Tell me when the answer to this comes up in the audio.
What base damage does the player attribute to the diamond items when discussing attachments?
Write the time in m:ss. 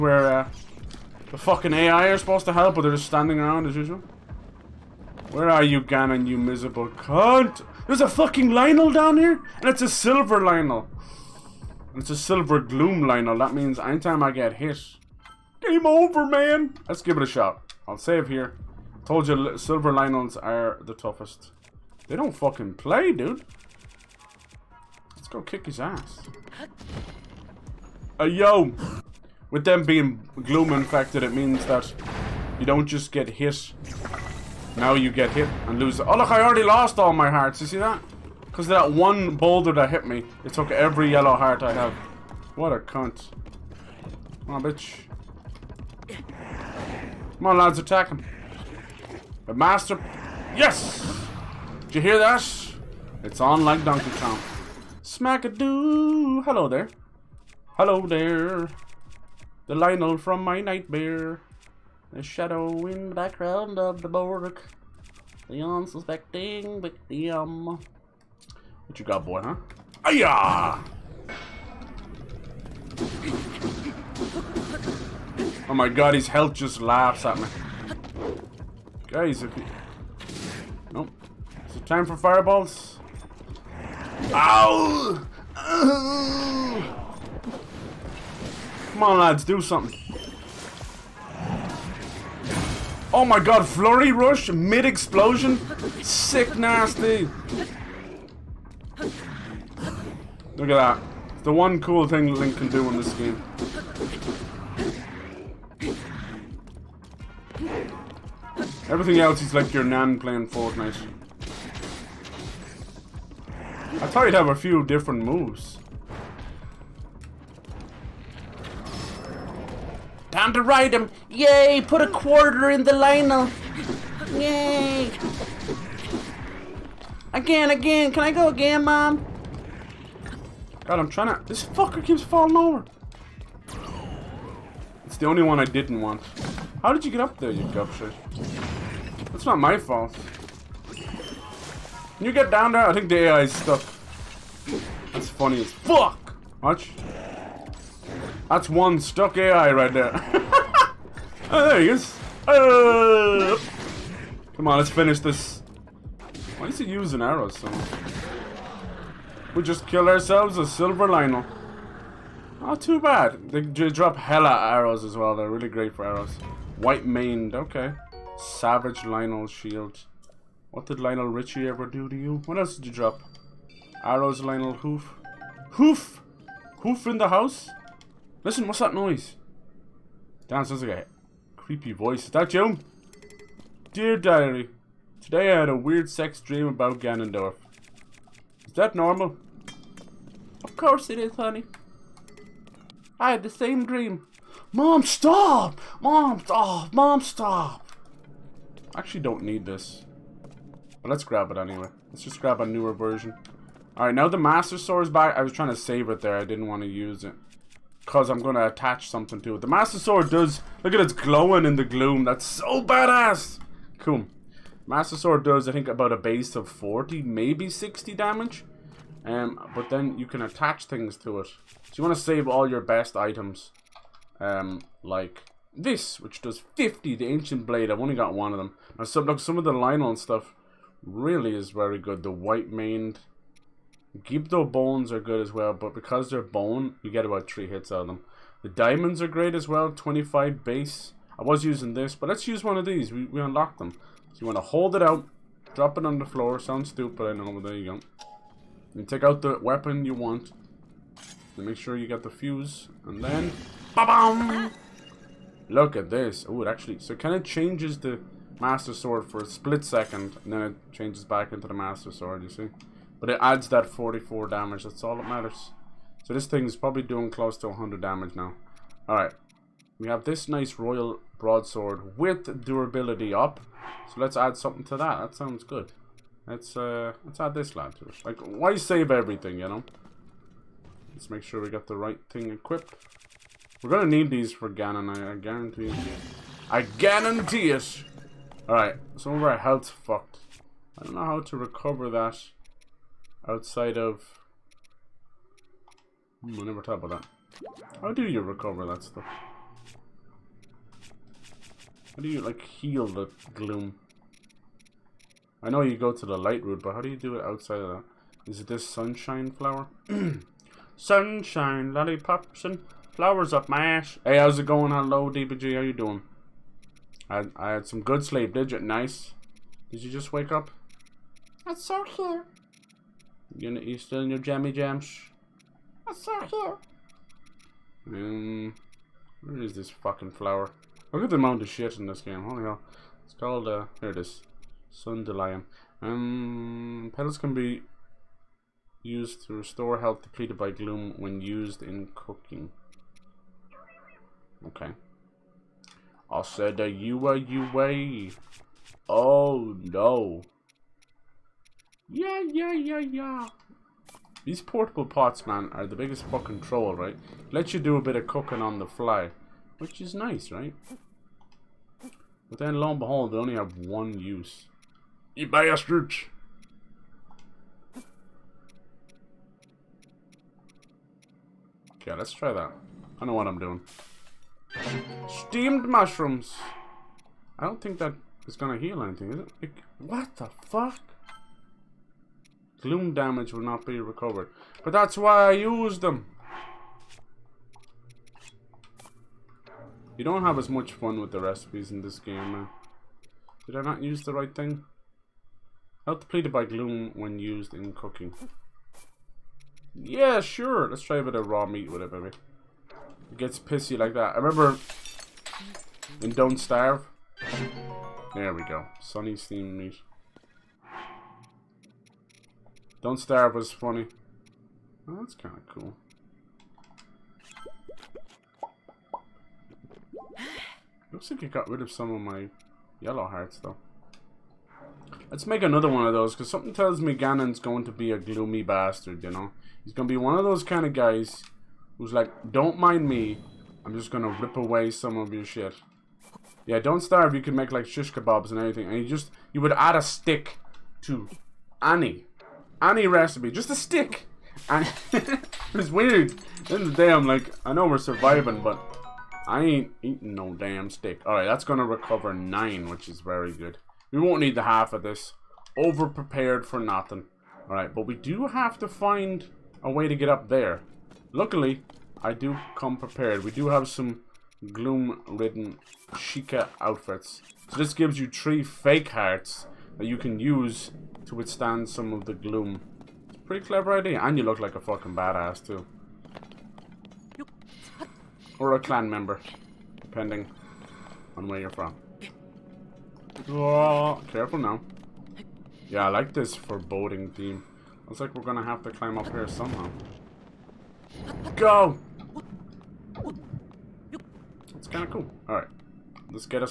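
3:59.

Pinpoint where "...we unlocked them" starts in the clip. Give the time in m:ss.
4:03.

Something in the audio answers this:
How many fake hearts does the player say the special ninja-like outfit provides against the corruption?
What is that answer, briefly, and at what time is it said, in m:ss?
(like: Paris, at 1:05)
3, at 7:48.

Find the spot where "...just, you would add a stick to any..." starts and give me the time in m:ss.
7:19.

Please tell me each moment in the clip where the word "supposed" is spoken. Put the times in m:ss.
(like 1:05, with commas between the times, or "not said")
0:02.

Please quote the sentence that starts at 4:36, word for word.
Let's uh, let's add this lad to it.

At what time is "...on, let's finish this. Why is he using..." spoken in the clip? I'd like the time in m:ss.
2:34.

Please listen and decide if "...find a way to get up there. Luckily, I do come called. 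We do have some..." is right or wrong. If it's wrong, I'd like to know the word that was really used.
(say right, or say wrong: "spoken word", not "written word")
wrong: "prepared", not "called".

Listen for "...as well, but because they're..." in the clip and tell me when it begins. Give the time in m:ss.
3:55.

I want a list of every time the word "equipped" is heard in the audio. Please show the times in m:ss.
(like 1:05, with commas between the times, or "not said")
4:42.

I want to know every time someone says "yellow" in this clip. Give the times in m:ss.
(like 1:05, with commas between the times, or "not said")
0:41, 7:02.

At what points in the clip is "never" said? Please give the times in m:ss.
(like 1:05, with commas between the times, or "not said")
4:56.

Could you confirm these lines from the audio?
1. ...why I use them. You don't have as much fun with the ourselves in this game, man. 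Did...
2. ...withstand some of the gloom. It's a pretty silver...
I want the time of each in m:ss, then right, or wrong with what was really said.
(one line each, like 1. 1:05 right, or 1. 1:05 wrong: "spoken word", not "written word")
1. 6:25 wrong: "recipes", not "ourselves"
2. 7:51 wrong: "clever", not "silver".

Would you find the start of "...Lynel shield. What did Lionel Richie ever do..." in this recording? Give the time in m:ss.
2:49.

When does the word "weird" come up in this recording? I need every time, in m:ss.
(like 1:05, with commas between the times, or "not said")
3:05, 7:25.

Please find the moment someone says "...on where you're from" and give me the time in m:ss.
8:01.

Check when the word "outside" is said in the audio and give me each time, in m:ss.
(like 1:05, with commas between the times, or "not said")
4:53, 5:07.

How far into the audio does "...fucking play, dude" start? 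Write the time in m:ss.
0:22.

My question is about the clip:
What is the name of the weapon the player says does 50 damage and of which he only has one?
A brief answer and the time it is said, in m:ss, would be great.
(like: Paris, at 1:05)
Ancient Blade, at 3:47.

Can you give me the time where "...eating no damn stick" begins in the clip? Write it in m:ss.
7:30.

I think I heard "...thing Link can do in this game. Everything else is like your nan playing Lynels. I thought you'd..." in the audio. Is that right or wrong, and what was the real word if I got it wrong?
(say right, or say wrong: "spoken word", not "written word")
wrong: "Fortnite", not "Lynels".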